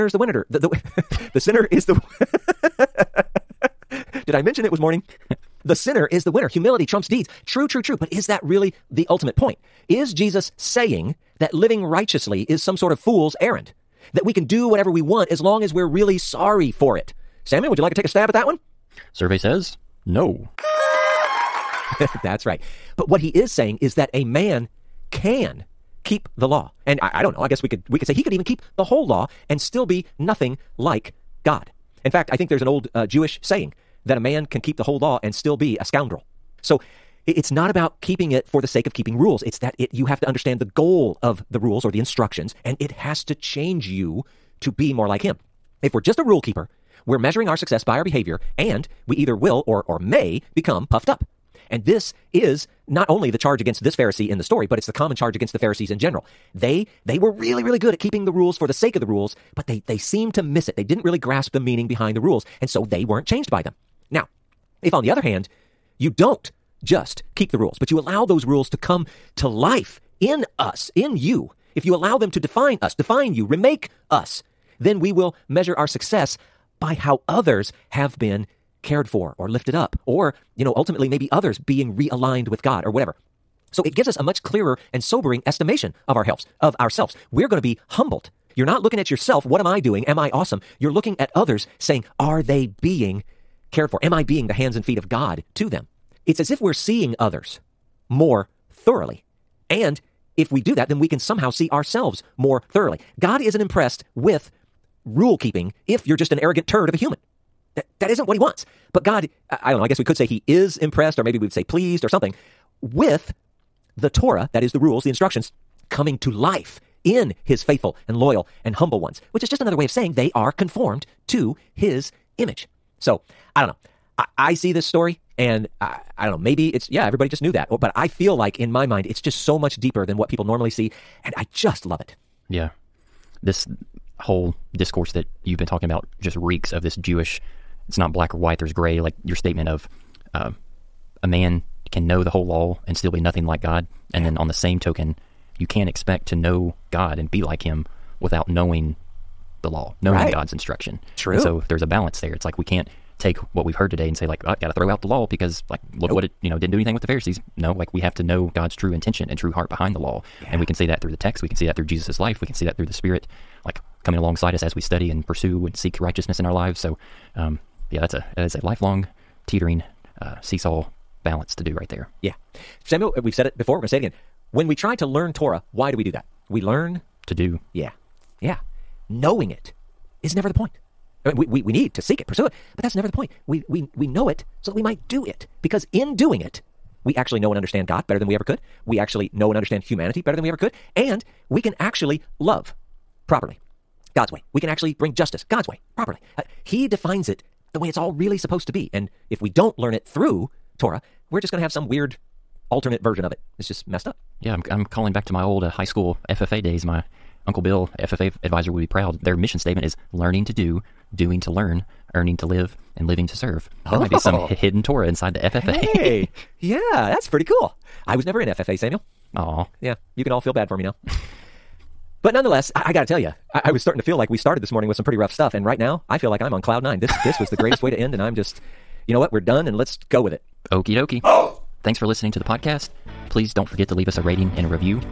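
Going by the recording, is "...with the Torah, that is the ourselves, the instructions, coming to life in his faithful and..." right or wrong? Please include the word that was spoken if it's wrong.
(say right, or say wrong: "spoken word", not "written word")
wrong: "rules", not "ourselves".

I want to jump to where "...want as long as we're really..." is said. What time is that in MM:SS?
00:15.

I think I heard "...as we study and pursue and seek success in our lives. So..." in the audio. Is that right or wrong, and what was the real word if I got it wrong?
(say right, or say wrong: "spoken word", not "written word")
wrong: "righteousness", not "success".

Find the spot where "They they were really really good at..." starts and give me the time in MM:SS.
00:56.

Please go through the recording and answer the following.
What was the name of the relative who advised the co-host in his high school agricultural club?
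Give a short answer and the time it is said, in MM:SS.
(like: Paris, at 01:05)
Uncle Bill, at 03:27.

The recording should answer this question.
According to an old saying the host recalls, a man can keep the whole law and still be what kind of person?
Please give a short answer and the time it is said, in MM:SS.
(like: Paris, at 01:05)
a scoundrel, at 00:35.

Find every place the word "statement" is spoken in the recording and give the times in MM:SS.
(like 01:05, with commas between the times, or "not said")
02:19, 03:29.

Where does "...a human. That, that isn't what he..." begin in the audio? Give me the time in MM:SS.
01:46.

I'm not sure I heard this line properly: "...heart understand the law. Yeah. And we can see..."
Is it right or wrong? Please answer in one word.
wrong.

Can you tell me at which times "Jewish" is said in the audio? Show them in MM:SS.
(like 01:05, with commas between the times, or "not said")
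00:33, 02:16.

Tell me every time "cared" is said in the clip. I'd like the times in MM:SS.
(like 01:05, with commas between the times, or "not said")
01:18, 01:33.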